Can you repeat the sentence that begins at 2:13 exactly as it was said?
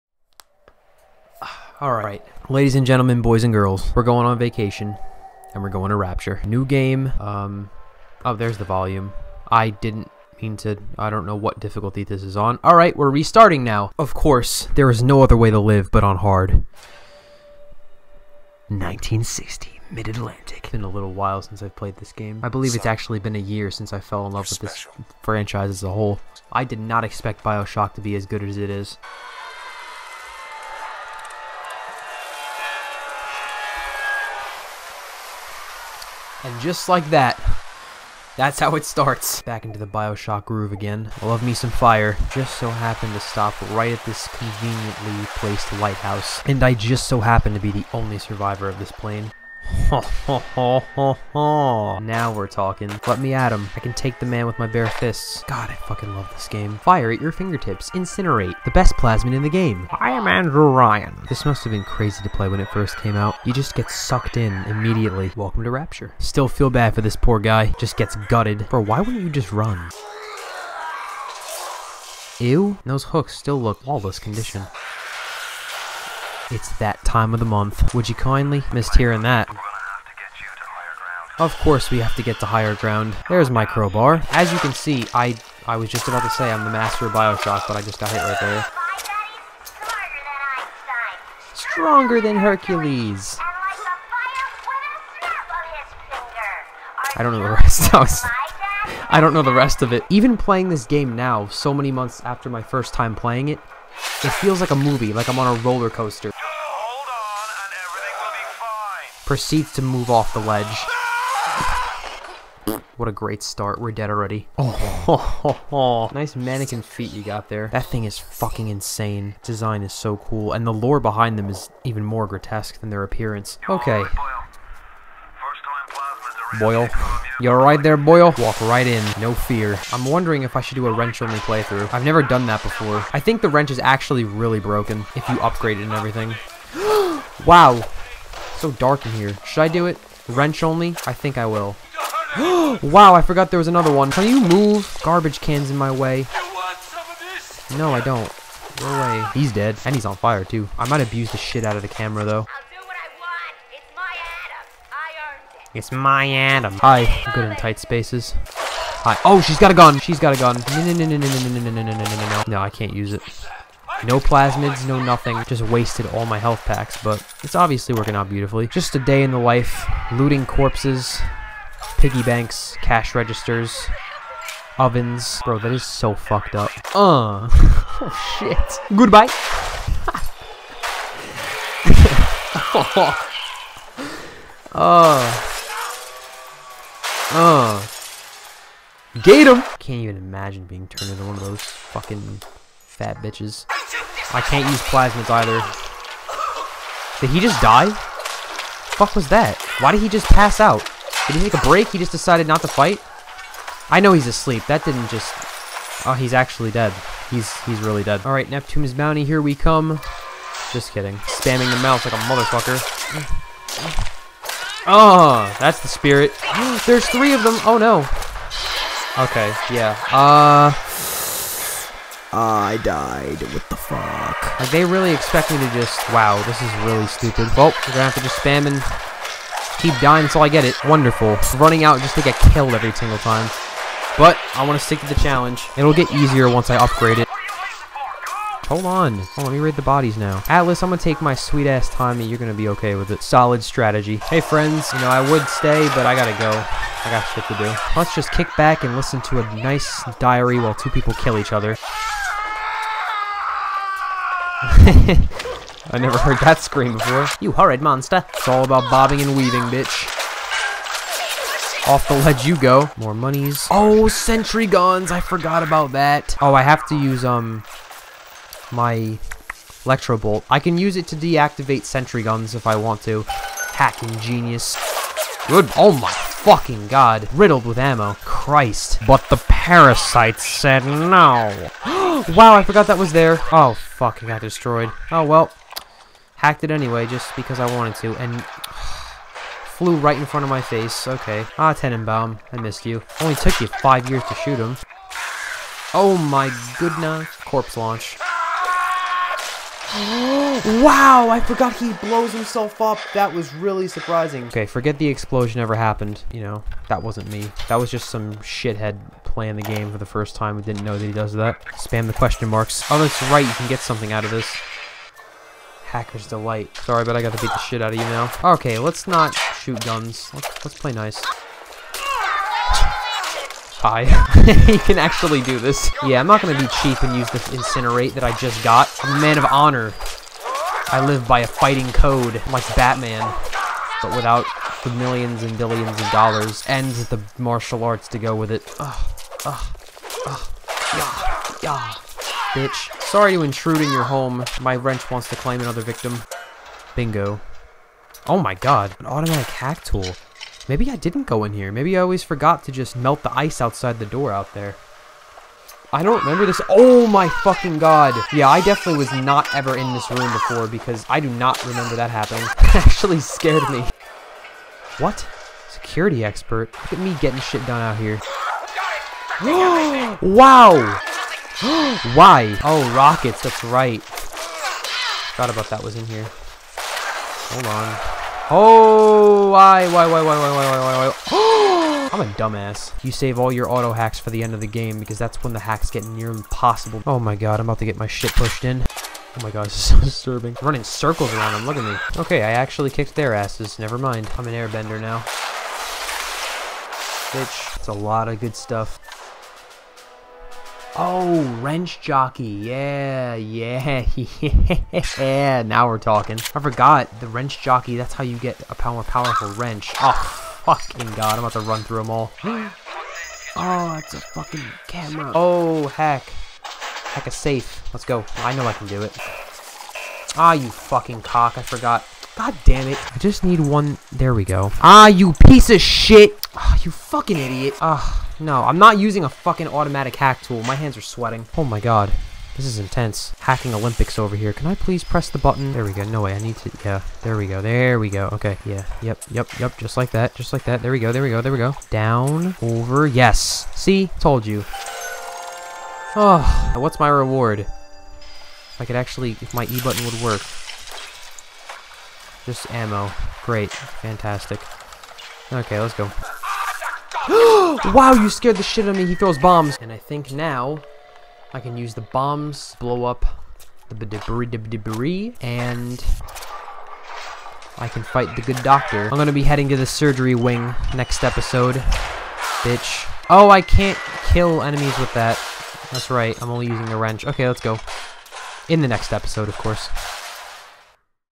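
I think the wrench is actually really broken if you upgrade it and everything.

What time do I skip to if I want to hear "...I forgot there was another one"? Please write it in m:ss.
2:23.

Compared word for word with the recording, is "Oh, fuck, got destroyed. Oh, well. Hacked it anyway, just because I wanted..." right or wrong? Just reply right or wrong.
right.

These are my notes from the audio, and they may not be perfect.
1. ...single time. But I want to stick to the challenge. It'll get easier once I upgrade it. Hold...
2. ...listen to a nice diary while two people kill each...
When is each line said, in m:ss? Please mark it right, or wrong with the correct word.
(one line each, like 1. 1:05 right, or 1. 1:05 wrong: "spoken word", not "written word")
1. 3:52 right
2. 4:08 right.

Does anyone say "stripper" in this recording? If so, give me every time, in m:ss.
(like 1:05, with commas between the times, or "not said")
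not said.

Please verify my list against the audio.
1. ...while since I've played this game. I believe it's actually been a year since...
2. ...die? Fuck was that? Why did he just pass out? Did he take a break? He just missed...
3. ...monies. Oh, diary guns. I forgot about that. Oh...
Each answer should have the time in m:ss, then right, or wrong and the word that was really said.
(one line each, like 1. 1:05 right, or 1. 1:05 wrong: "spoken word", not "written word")
1. 0:21 right
2. 3:17 wrong: "decided", not "missed"
3. 4:23 wrong: "sentry", not "diary".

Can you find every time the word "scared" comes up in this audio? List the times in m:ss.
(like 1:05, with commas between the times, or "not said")
6:03, 7:38.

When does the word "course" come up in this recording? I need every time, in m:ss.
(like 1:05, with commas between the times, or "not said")
0:14, 1:21, 7:59.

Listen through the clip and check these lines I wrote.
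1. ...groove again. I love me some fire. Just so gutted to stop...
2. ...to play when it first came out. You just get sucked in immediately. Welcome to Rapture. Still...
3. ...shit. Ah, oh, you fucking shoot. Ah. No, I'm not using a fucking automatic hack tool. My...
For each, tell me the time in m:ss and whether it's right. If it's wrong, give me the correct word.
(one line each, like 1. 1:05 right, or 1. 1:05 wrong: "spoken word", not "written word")
1. 0:40 wrong: "happened", not "gutted"
2. 1:02 right
3. 7:05 wrong: "idiot", not "shoot".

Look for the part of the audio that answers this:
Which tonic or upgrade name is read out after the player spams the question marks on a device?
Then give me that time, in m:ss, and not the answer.
5:15.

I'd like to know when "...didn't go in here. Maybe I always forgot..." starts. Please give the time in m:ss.
5:50.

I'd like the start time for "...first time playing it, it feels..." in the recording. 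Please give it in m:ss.
1:42.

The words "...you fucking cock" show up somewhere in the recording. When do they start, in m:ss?
7:00.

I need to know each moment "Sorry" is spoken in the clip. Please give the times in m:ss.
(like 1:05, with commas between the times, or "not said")
5:16, 5:43.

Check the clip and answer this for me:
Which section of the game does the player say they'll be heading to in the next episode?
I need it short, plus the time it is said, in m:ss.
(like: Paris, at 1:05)
the surgery wing, at 7:49.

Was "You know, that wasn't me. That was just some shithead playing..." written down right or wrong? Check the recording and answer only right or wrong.
right.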